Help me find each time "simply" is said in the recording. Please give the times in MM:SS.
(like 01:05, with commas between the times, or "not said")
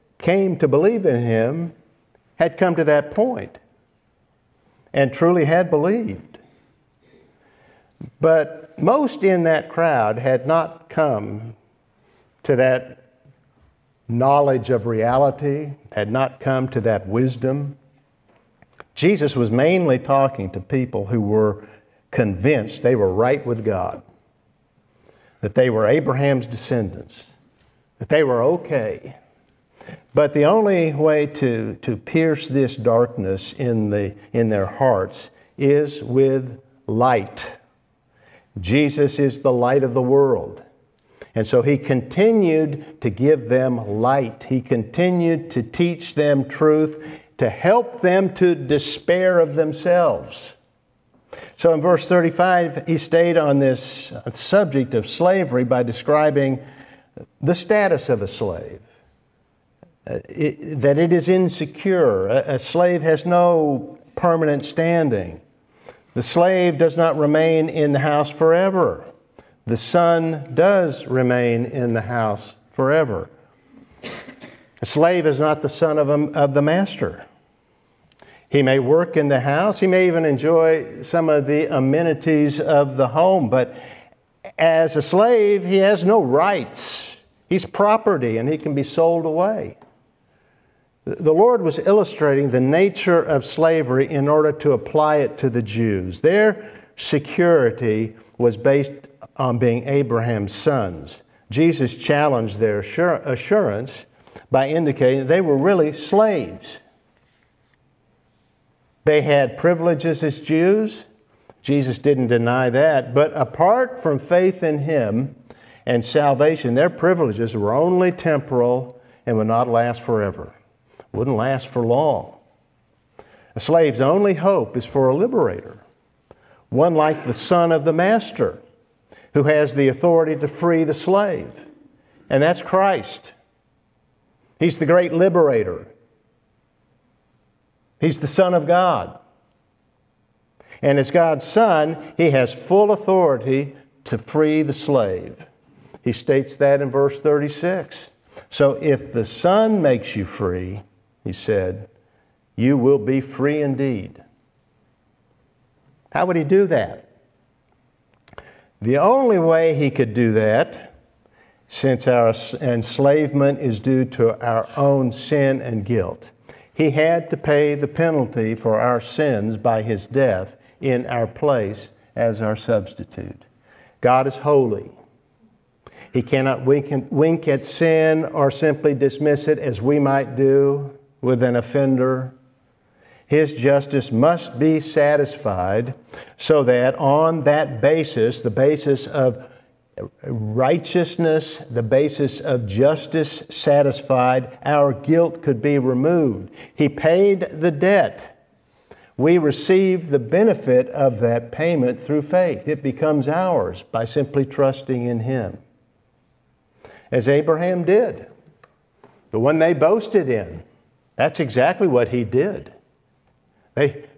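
02:58, 03:24.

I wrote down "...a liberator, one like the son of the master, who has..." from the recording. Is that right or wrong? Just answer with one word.
right.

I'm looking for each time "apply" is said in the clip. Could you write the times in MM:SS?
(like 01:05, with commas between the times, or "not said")
01:34.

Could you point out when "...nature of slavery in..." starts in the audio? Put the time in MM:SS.
01:32.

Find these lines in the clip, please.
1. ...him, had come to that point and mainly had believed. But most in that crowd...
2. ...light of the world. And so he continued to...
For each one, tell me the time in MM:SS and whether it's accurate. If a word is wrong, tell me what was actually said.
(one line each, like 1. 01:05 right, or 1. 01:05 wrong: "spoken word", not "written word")
1. 00:01 wrong: "truly", not "mainly"
2. 00:39 right.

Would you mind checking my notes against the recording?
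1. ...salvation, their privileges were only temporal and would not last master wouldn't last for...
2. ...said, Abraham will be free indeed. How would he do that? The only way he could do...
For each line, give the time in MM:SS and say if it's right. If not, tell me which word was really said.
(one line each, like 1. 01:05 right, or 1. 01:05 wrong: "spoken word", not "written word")
1. 01:56 wrong: "forever", not "master"
2. 02:31 wrong: "You", not "Abraham".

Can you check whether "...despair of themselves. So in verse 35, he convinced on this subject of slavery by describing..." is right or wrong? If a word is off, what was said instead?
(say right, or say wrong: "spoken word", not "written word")
wrong: "stayed", not "convinced".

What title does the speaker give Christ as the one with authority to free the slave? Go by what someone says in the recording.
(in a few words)
The great liberator.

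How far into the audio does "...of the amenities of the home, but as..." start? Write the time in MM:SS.
01:21.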